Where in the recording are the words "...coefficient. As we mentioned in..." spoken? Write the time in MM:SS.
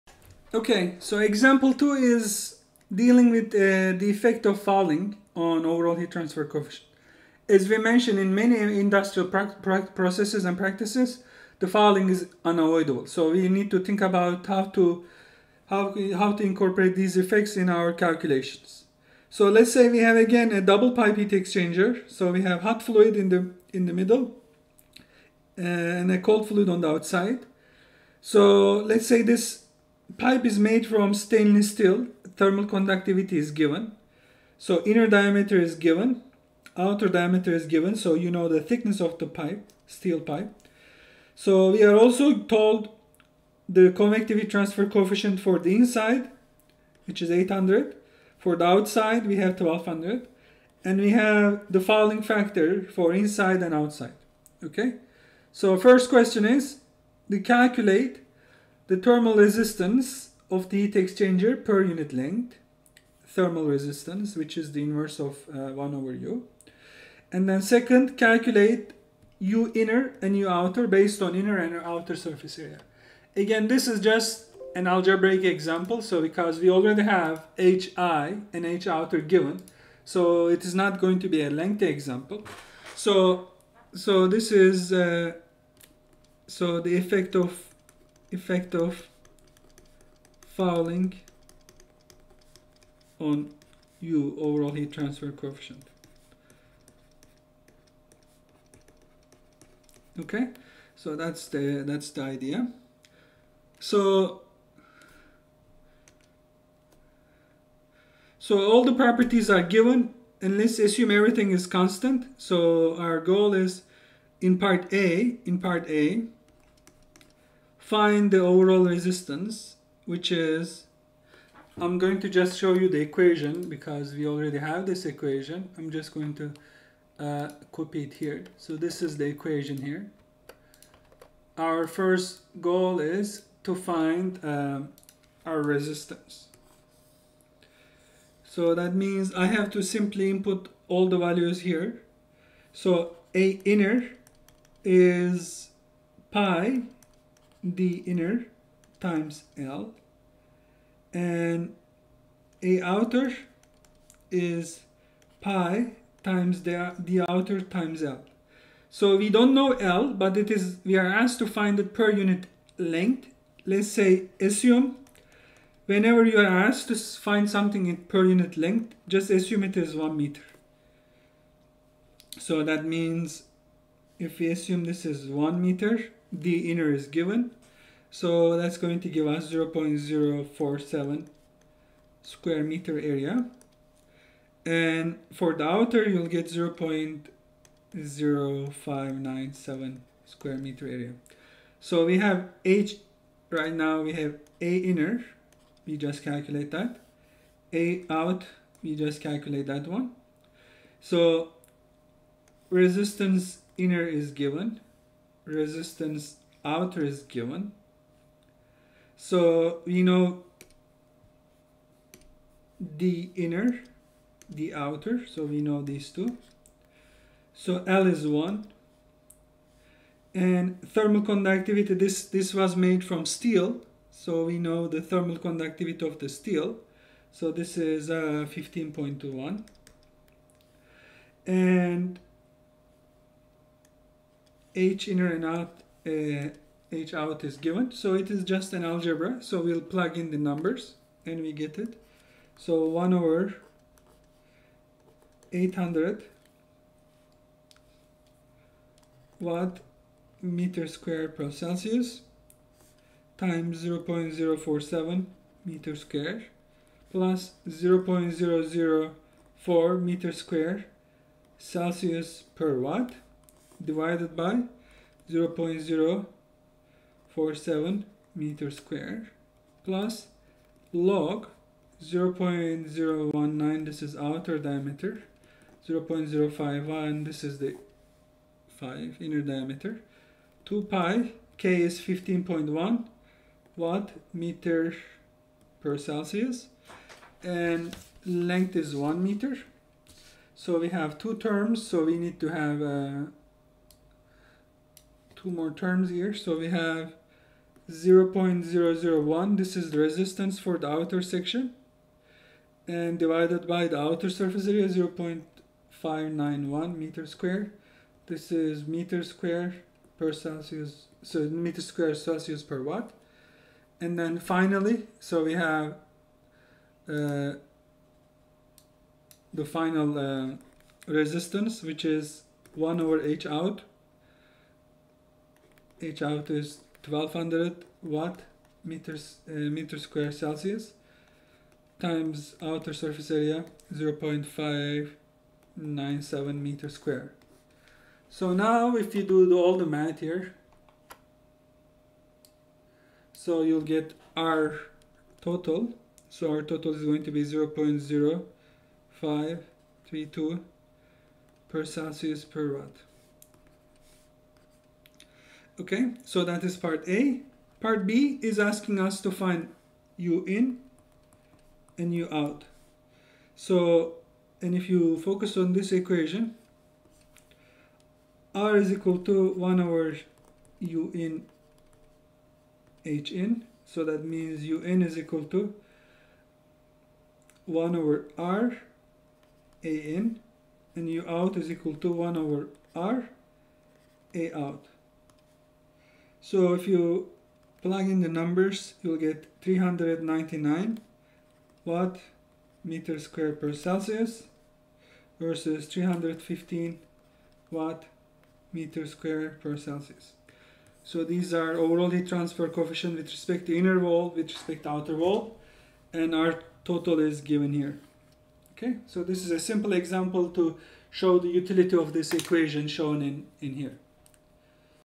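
00:06.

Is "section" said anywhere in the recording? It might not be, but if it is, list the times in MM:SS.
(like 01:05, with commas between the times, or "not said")
05:01.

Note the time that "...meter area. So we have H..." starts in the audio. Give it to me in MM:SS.
03:10.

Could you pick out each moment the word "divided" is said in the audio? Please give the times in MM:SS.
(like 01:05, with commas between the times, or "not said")
04:23, 05:03.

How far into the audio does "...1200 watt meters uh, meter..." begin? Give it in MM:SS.
05:27.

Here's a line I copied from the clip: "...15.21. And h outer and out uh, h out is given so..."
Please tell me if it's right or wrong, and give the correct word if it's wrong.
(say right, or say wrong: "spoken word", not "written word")
wrong: "inner", not "outer".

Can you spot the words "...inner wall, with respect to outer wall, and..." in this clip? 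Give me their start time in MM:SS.
06:43.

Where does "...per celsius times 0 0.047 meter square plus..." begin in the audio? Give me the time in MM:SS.
04:11.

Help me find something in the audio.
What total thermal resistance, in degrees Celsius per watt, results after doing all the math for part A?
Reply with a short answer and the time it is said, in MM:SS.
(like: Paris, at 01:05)
0.0532, at 05:47.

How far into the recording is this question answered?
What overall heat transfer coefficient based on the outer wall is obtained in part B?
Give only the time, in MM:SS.
06:35.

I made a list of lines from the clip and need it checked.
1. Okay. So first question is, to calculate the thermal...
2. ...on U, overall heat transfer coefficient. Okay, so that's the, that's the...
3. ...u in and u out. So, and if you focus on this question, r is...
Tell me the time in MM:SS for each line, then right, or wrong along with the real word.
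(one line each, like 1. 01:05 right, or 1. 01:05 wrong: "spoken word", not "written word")
1. 00:54 right
2. 01:33 right
3. 06:00 wrong: "equation", not "question".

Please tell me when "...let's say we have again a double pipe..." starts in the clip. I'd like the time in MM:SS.
00:19.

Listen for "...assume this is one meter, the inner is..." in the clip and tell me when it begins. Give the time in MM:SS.
02:54.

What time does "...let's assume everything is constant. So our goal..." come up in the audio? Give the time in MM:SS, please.
01:50.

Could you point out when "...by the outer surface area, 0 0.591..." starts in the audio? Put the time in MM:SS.
05:03.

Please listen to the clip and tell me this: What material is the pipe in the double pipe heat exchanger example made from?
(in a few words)
stainless steel.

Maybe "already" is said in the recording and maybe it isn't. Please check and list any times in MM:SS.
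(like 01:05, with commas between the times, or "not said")
01:16, 02:04.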